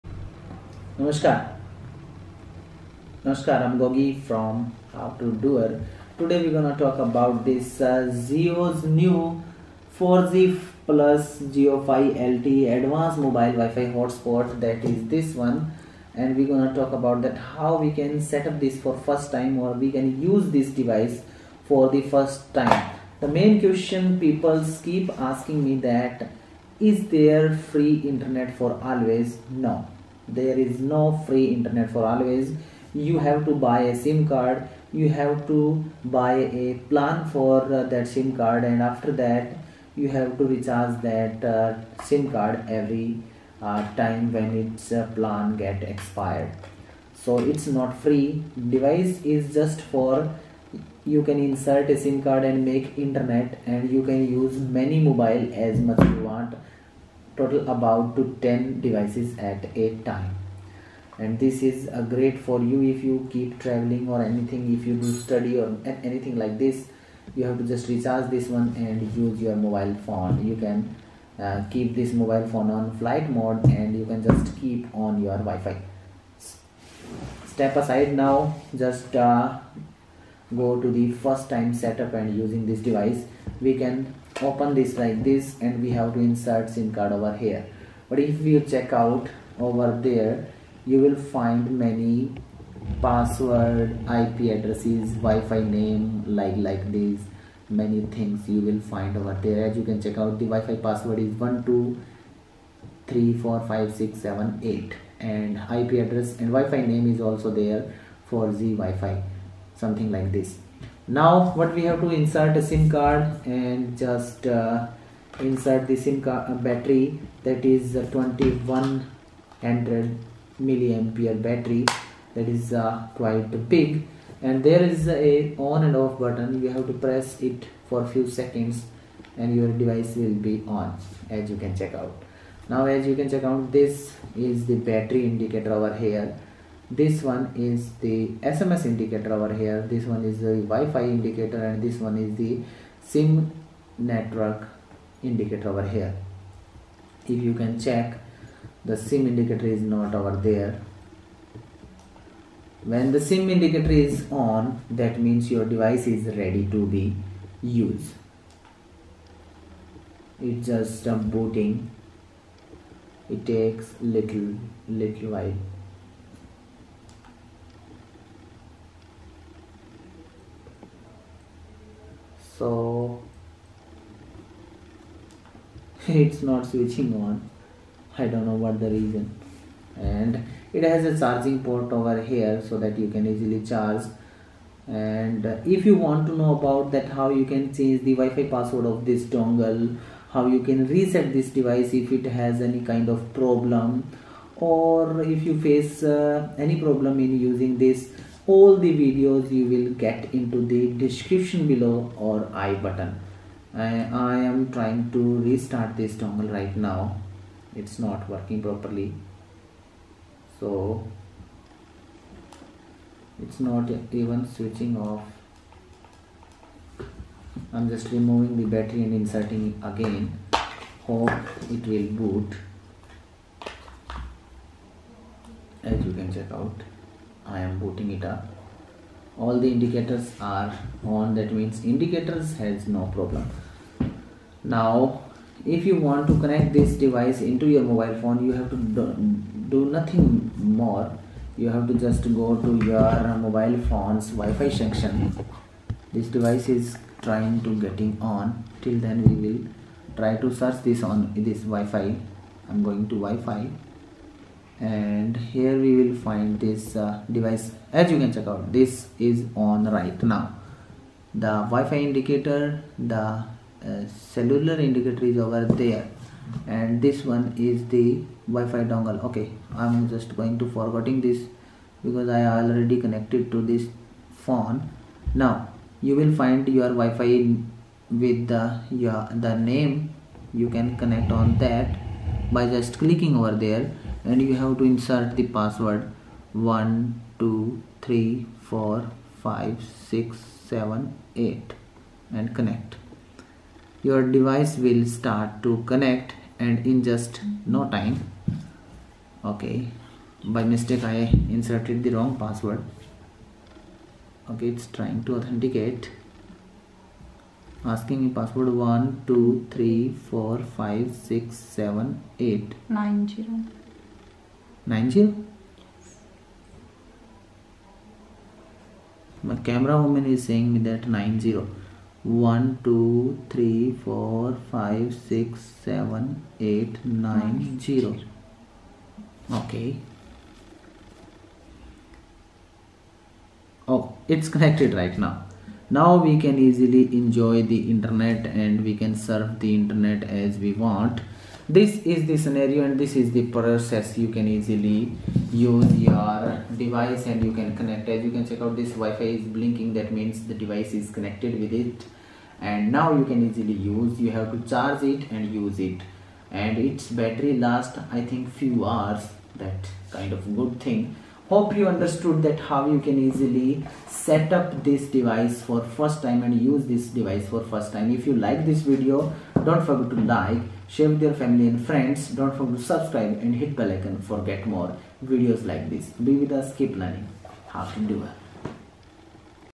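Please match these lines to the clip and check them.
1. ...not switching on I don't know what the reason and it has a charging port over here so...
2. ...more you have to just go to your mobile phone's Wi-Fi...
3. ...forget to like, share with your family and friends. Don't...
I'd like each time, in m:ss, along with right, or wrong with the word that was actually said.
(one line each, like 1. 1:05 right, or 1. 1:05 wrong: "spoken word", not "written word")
1. 2:56 right
2. 4:00 right
3. 6:09 right.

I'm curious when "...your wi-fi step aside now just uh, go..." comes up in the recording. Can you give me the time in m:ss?
1:15.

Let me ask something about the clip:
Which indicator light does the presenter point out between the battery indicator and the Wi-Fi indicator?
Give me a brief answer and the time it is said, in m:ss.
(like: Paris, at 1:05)
SMS indicator, at 2:18.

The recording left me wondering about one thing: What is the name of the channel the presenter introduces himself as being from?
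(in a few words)
How to Doer.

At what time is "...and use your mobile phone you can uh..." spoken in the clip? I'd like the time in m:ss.
1:08.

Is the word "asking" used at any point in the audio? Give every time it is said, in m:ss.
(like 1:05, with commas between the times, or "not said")
0:25, 5:07.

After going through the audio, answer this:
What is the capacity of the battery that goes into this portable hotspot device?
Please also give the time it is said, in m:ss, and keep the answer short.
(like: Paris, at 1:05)
2100 mAh, at 1:59.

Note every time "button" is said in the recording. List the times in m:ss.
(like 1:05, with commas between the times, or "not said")
2:06, 3:22.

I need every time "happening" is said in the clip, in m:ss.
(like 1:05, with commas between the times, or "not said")
not said.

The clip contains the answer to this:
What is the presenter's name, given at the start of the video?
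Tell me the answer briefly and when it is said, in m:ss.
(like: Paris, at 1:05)
Gogi, at 0:03.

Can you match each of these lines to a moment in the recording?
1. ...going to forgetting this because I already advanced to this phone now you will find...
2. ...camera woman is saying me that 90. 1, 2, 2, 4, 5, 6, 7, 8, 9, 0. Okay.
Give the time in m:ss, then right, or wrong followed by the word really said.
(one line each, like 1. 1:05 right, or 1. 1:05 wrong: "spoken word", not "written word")
1. 4:30 wrong: "connected", not "advanced"
2. 5:19 wrong: "3", not "2".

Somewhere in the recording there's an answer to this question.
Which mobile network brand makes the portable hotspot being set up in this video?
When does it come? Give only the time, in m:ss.
0:08.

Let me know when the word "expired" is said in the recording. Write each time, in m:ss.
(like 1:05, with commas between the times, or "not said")
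0:45.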